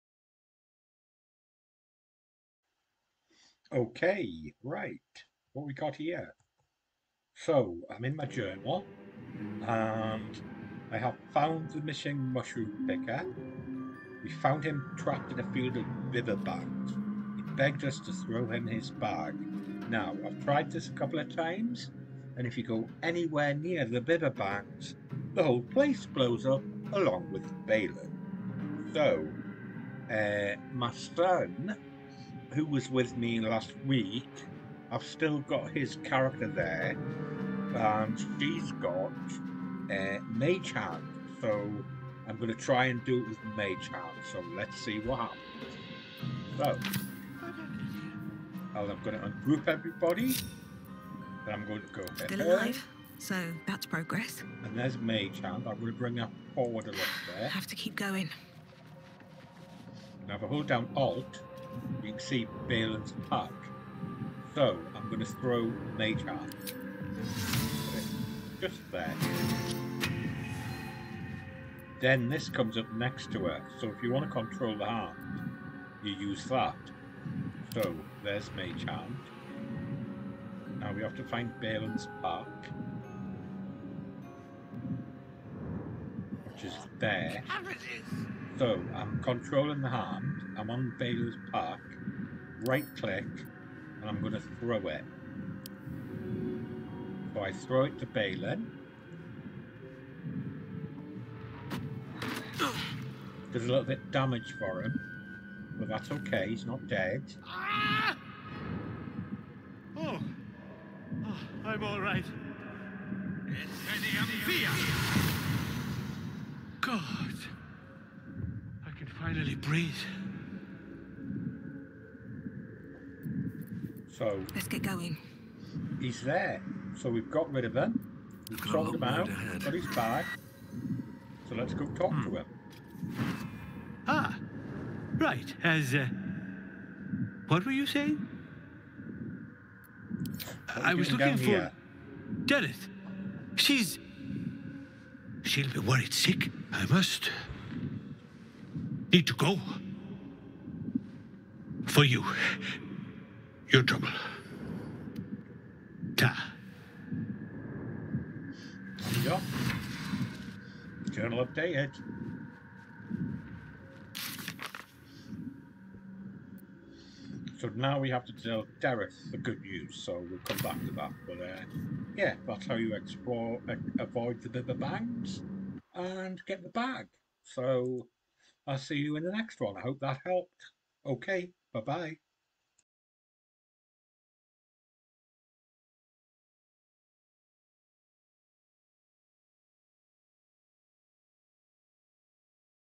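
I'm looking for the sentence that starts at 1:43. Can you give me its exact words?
Does a little bit damage for him, but that's okay, he's not dead.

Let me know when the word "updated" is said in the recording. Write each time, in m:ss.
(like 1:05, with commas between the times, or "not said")
2:41.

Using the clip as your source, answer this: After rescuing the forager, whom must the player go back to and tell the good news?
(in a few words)
Dareth.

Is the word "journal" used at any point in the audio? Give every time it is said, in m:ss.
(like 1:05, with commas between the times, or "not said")
0:08, 2:41.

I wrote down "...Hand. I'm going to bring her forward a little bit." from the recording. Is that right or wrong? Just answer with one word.
right.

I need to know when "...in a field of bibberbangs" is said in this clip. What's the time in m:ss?
0:15.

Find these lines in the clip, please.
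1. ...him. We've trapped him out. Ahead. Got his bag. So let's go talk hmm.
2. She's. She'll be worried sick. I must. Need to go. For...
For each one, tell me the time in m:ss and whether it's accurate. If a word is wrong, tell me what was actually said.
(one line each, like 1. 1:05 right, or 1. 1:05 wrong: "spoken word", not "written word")
1. 2:07 wrong: "sorted", not "trapped"
2. 2:23 right.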